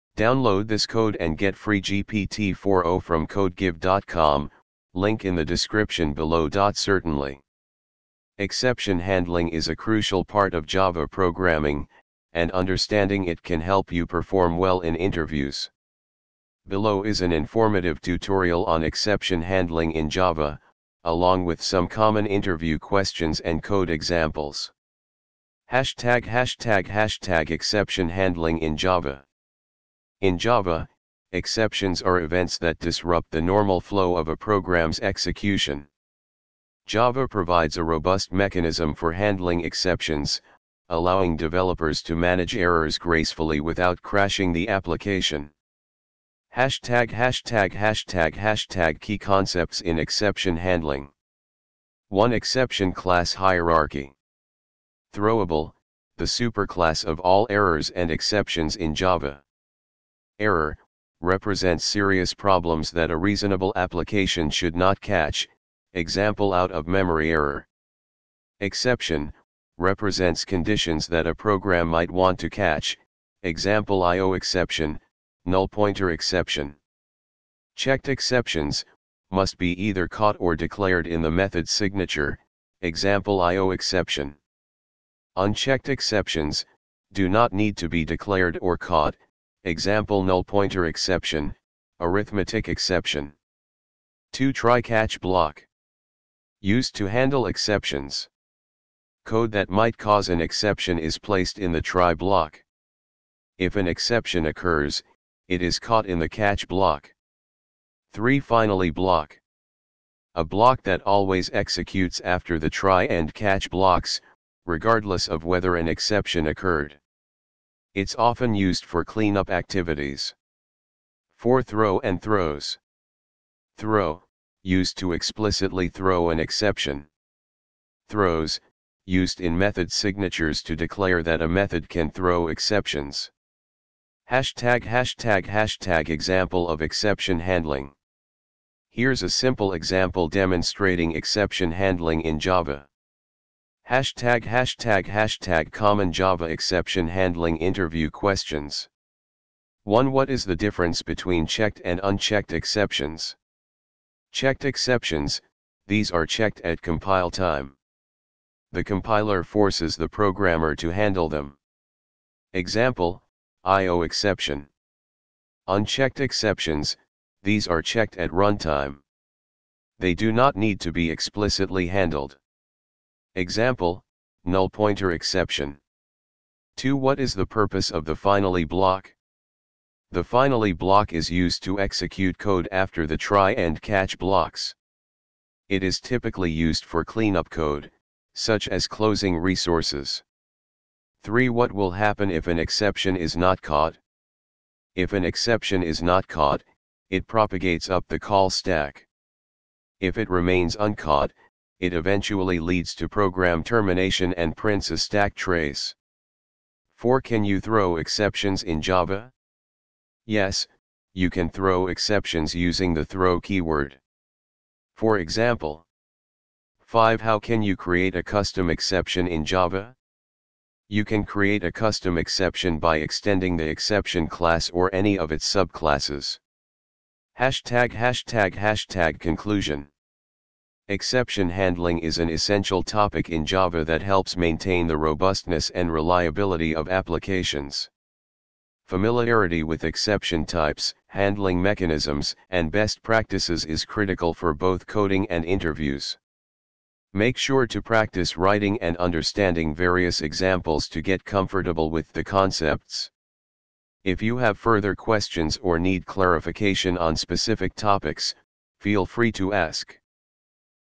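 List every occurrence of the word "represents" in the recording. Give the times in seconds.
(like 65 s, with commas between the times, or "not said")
61 s, 69 s.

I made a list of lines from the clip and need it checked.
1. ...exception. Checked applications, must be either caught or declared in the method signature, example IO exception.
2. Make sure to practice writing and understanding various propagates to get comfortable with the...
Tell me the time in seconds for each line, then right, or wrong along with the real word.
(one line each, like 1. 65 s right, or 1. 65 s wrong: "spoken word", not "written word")
1. 76 s wrong: "exceptions", not "applications"
2. 247 s wrong: "examples", not "propagates".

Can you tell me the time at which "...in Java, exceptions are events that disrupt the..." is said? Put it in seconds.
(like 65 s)
30 s.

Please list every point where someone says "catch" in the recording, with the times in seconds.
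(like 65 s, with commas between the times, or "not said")
64 s, 72 s, 94 s, 106 s, 113 s, 183 s.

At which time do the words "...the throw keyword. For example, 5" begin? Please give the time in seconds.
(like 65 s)
212 s.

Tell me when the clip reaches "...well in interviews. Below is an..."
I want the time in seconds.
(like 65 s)
14 s.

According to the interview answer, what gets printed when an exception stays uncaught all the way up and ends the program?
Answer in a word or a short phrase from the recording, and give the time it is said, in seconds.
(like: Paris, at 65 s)
A stack trace, at 204 s.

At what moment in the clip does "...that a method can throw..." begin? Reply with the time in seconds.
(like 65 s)
131 s.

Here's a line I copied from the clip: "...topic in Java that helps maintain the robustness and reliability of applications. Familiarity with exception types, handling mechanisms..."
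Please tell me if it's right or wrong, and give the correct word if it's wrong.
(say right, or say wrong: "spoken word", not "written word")
right.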